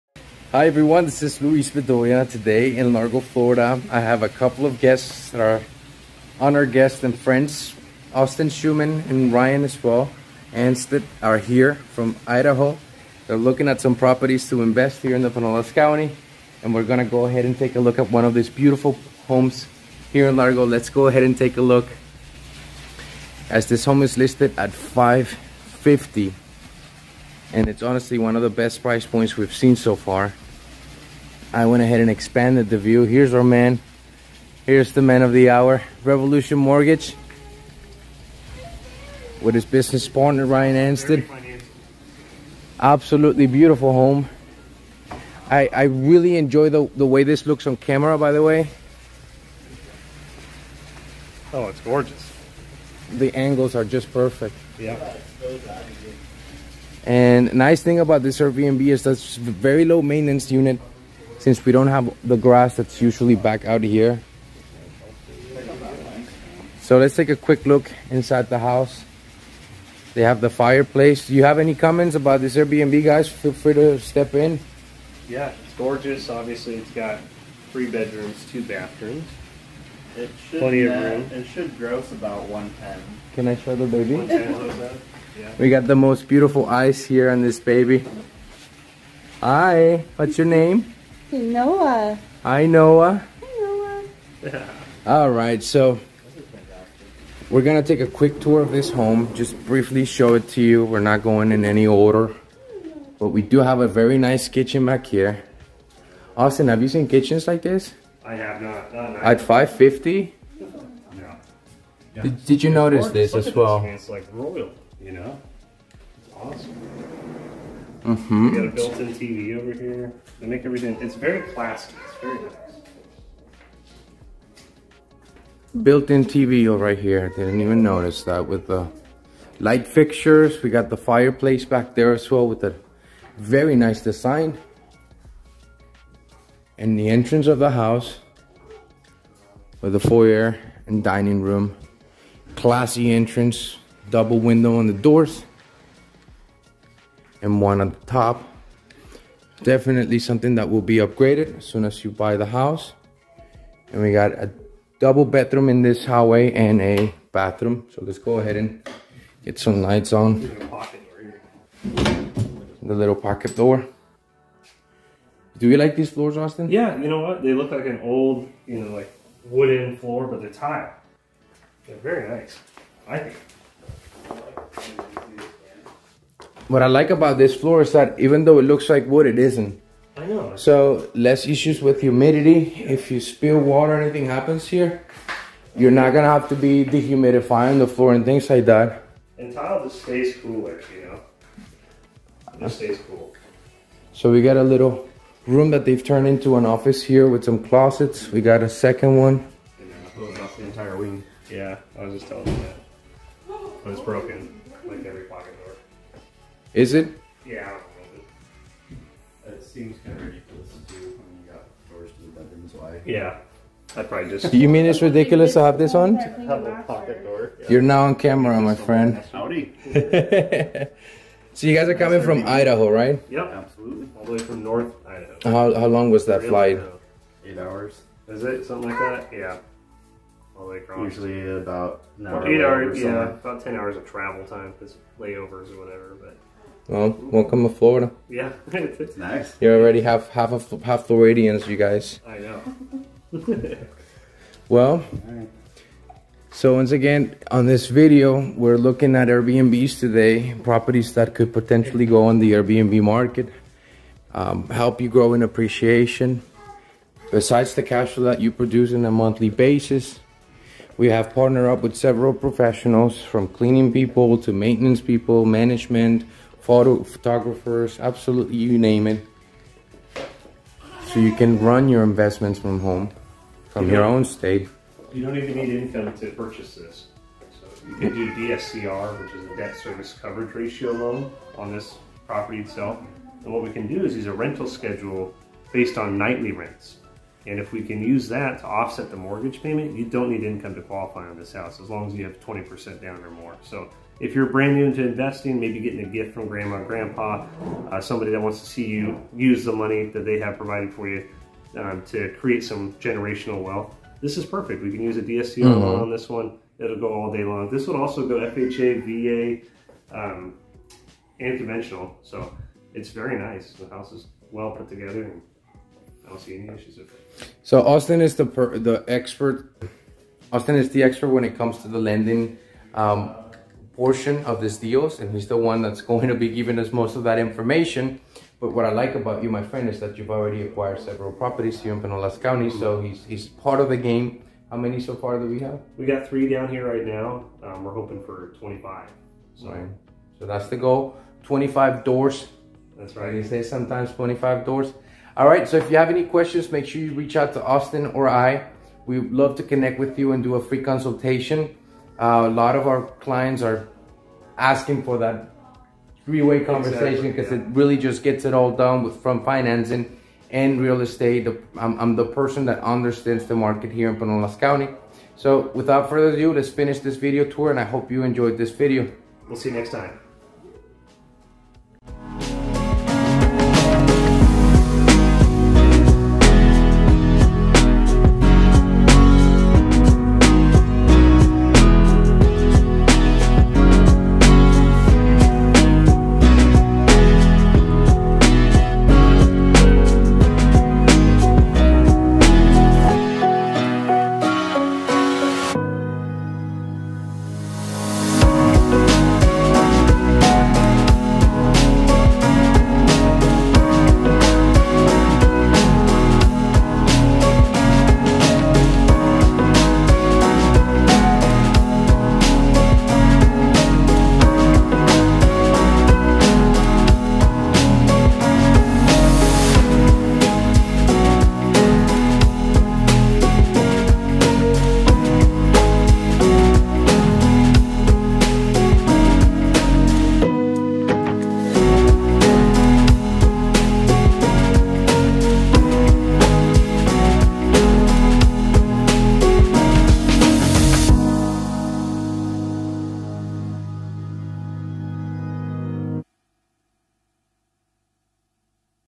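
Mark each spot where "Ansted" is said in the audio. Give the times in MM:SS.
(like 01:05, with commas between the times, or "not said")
00:40.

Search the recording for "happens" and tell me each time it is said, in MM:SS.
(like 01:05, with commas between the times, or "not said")
03:04.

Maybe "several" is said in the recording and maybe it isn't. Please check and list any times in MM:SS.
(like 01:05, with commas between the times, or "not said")
04:21, 05:30.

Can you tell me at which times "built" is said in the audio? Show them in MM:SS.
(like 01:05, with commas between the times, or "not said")
01:58, 02:05.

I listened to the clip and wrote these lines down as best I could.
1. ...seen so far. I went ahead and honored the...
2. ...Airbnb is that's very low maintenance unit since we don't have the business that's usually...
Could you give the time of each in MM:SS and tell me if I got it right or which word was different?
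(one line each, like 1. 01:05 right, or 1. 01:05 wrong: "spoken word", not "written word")
1. 00:29 wrong: "expanded", not "honored"
2. 00:58 wrong: "grass", not "business".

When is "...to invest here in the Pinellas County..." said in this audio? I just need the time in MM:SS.
00:14.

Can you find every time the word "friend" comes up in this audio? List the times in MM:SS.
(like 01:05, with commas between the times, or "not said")
00:07, 03:38, 05:29.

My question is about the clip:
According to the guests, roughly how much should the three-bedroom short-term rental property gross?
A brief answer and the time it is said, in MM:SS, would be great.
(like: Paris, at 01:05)
110, at 01:22.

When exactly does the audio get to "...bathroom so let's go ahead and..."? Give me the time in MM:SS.
02:37.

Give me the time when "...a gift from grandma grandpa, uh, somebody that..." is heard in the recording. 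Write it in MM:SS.
04:56.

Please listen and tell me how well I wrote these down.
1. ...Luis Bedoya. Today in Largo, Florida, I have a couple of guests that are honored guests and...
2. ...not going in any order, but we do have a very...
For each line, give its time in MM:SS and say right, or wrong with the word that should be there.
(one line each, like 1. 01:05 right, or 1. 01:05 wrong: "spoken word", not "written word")
1. 00:01 right
2. 01:40 right.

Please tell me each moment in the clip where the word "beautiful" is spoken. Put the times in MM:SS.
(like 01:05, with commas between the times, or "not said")
00:18, 00:43, 01:26.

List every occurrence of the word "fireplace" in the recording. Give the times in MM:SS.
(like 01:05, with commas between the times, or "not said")
01:10, 02:10.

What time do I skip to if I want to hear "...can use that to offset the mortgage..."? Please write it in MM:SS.
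04:47.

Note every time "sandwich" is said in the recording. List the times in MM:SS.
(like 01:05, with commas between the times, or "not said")
not said.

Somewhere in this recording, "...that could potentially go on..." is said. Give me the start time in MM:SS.
04:11.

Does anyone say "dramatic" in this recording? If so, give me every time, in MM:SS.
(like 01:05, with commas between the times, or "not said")
not said.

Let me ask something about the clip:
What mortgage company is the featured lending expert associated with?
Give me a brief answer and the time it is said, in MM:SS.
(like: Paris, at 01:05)
Revolution Mortgage, at 00:36.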